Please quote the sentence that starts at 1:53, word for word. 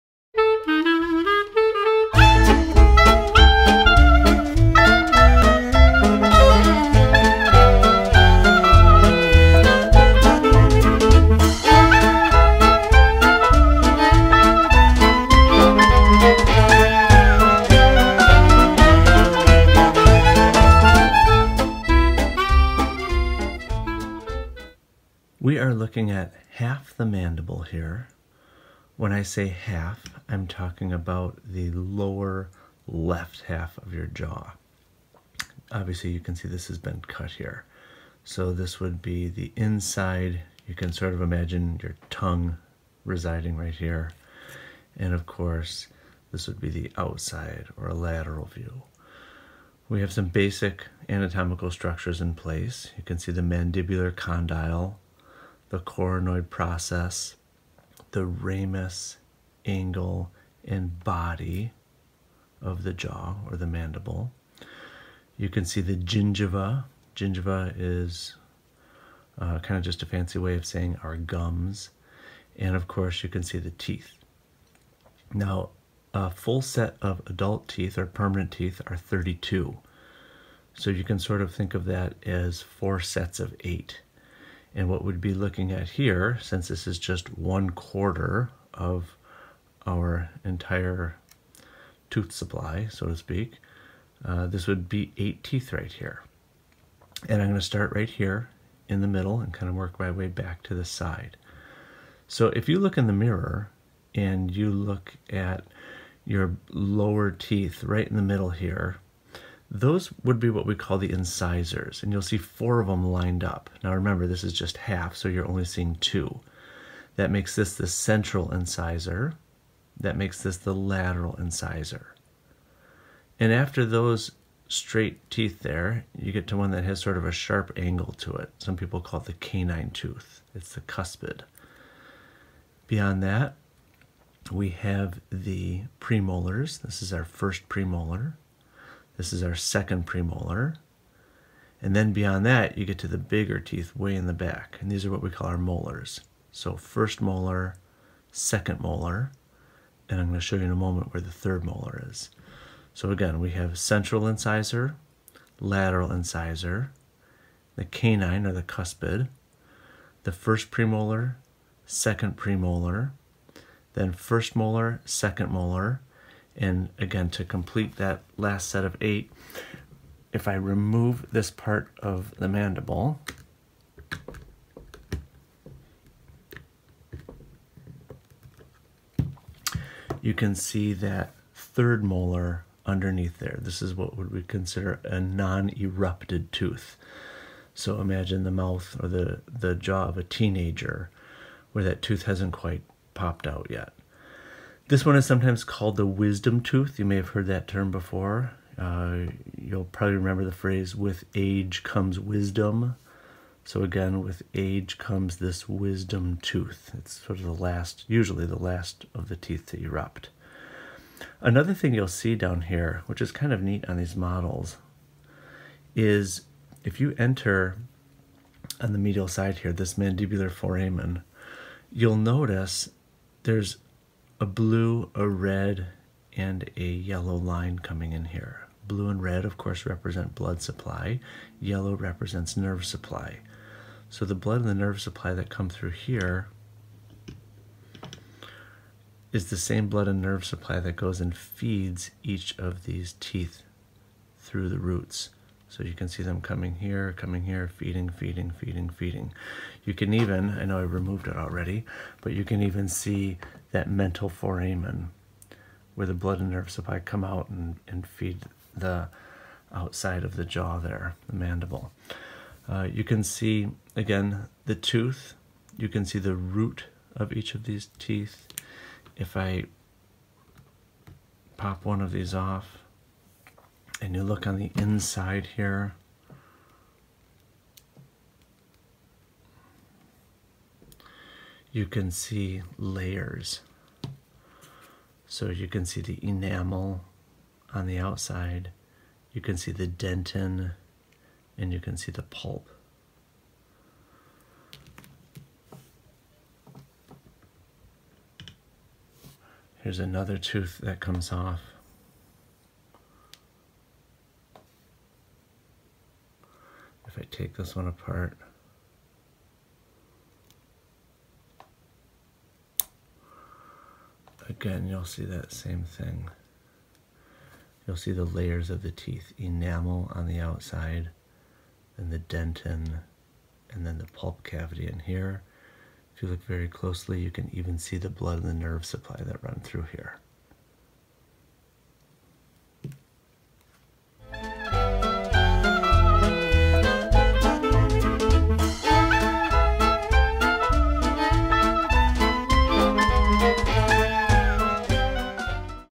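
Now remember, this is just half, so you're only seeing two.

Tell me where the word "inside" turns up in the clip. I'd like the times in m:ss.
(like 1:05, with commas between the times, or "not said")
0:39, 4:34.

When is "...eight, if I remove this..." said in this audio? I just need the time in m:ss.
2:49.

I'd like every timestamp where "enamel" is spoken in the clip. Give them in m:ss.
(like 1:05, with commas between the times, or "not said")
4:46, 5:19.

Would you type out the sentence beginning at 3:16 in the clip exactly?
You may have heard that term before.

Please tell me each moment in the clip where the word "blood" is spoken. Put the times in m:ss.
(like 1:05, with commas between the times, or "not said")
3:50, 3:54, 3:59, 4:16, 5:28.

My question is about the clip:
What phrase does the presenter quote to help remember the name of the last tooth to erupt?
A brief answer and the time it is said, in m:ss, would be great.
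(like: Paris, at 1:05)
with age comes wisdom, at 3:20.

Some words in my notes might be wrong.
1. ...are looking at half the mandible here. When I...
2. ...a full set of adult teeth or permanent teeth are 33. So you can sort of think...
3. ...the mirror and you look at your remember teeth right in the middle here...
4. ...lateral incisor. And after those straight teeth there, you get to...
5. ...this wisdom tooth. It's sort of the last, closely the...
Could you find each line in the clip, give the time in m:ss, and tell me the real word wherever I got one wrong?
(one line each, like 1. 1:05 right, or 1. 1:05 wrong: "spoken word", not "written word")
1. 0:25 right
2. 1:16 wrong: "32", not "33"
3. 1:43 wrong: "lower", not "remember"
4. 2:00 right
5. 3:25 wrong: "usually", not "closely".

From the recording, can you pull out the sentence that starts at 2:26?
So first molar, second molar, and I'm going to show you in a moment where the third molar is.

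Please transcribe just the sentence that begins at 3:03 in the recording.
This is what would we consider a non-erupted tooth.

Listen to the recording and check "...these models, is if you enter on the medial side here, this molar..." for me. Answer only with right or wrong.
wrong.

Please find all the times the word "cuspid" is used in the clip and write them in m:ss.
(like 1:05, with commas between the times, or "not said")
2:10, 2:38.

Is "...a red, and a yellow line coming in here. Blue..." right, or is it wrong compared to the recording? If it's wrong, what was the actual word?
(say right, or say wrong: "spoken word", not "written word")
right.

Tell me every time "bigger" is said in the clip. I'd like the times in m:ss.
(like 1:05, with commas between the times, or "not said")
2:23.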